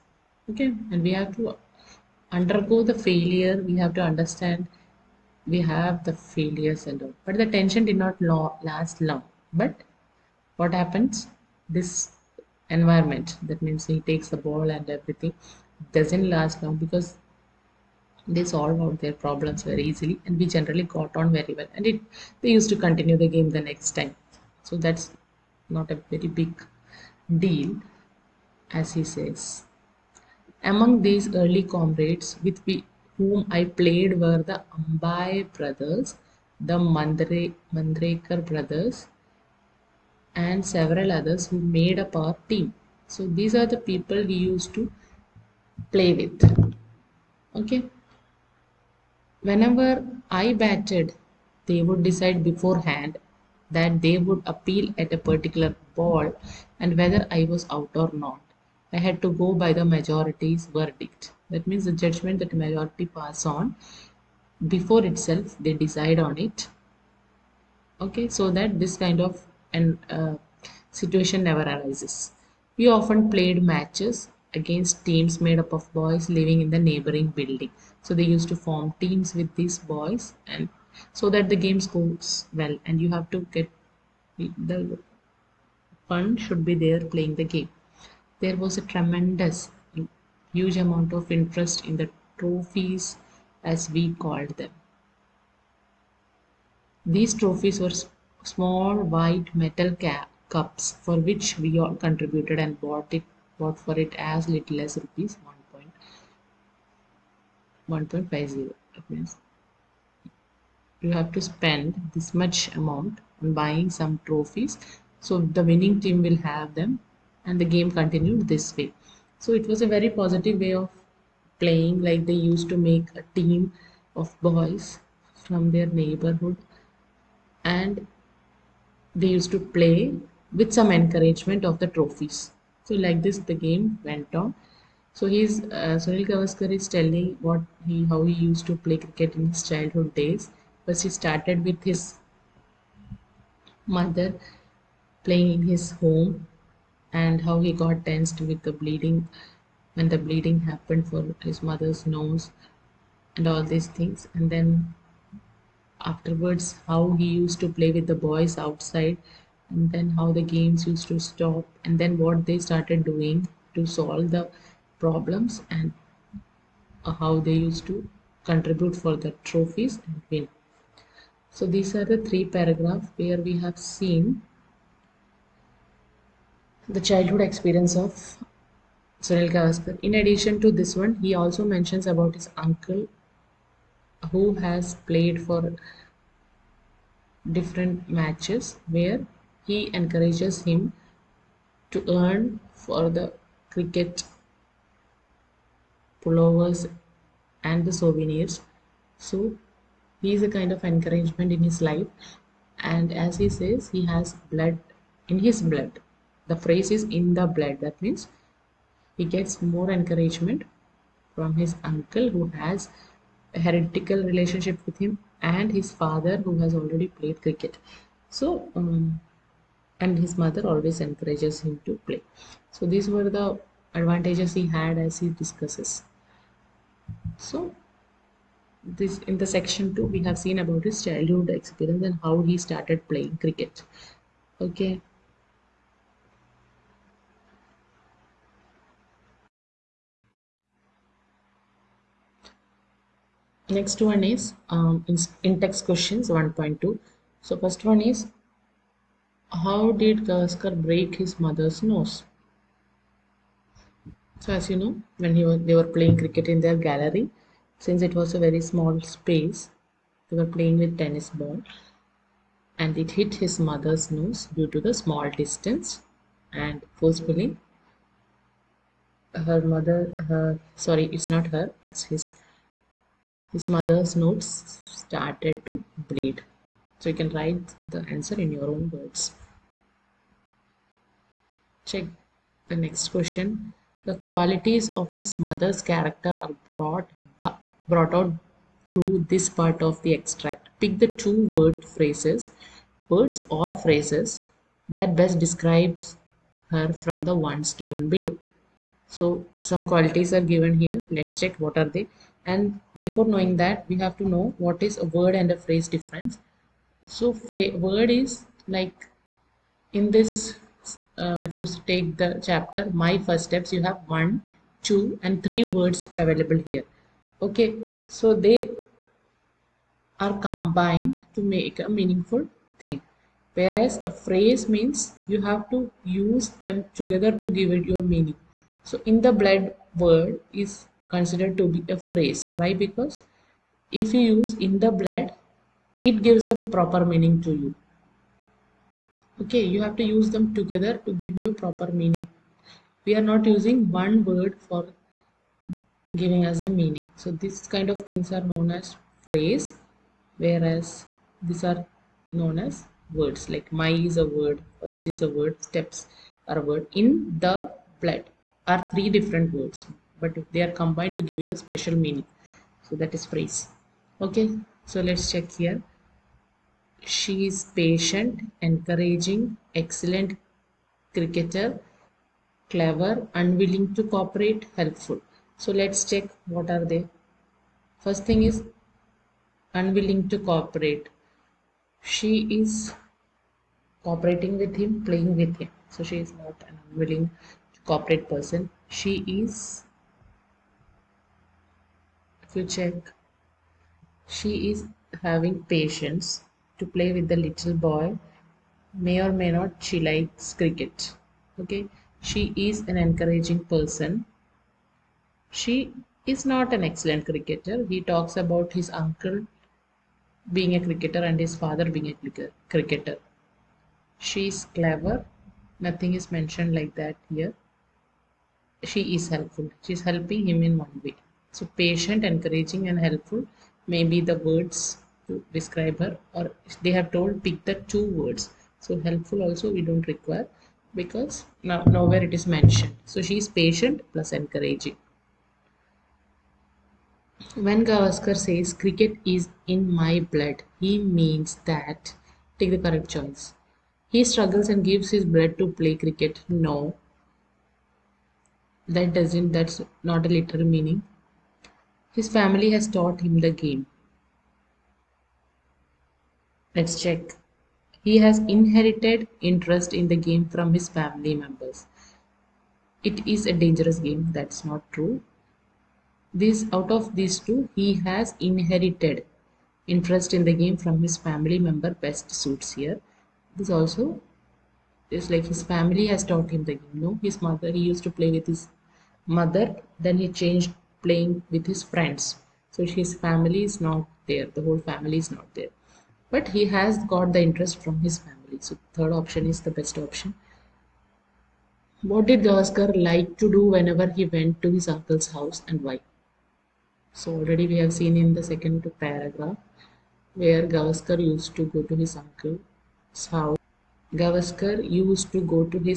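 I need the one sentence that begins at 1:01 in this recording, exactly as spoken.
That means the judgment that majority pass on before itself they decide on it.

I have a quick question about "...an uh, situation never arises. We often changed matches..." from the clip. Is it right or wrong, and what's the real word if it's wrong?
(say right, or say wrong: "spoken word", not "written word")
wrong: "played", not "changed".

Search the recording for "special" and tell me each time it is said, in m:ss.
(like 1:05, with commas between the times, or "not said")
6:01.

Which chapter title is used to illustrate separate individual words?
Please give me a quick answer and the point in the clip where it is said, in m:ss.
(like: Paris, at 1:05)
My First Steps, at 5:13.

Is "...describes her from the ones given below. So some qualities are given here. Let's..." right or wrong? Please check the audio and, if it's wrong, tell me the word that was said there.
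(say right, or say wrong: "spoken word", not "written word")
right.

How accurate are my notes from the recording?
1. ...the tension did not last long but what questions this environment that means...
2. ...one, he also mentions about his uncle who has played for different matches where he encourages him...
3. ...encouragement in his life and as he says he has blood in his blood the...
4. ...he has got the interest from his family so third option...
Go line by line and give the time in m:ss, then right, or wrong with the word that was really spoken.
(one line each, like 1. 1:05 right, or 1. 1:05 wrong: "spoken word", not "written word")
1. 0:07 wrong: "happens", not "questions"
2. 3:00 right
3. 3:20 right
4. 8:06 right.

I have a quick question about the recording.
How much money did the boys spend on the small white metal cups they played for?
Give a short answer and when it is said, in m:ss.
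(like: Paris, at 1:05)
1.50 rupees, at 1:45.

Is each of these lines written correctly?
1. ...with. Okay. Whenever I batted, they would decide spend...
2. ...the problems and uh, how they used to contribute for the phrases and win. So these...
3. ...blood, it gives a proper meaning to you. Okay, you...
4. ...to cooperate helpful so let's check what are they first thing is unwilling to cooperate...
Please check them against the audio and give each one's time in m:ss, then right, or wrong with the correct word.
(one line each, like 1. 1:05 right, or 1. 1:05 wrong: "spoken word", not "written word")
1. 0:46 wrong: "beforehand", not "spend"
2. 2:44 wrong: "trophies", not "phrases"
3. 5:34 right
4. 6:13 right.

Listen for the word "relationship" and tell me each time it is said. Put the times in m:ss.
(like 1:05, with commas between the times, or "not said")
3:34.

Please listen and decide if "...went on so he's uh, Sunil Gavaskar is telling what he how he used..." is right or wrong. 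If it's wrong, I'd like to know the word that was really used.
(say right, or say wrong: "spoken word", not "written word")
right.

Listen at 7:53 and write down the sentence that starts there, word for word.
This also is like his family has taught him the game.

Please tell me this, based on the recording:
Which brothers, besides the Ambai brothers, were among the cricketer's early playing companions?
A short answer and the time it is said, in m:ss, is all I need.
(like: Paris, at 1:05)
Mandrekar brothers, at 0:37.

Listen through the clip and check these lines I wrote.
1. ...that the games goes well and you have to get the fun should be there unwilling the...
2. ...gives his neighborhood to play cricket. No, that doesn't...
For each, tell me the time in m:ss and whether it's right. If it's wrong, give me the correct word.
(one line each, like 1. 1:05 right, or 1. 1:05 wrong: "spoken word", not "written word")
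1. 1:21 wrong: "playing", not "unwilling"
2. 7:24 wrong: "blood", not "neighborhood".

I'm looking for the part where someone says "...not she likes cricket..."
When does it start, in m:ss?
6:39.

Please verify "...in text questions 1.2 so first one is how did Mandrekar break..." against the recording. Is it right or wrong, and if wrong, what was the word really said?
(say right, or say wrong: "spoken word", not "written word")
wrong: "Gavaskar", not "Mandrekar".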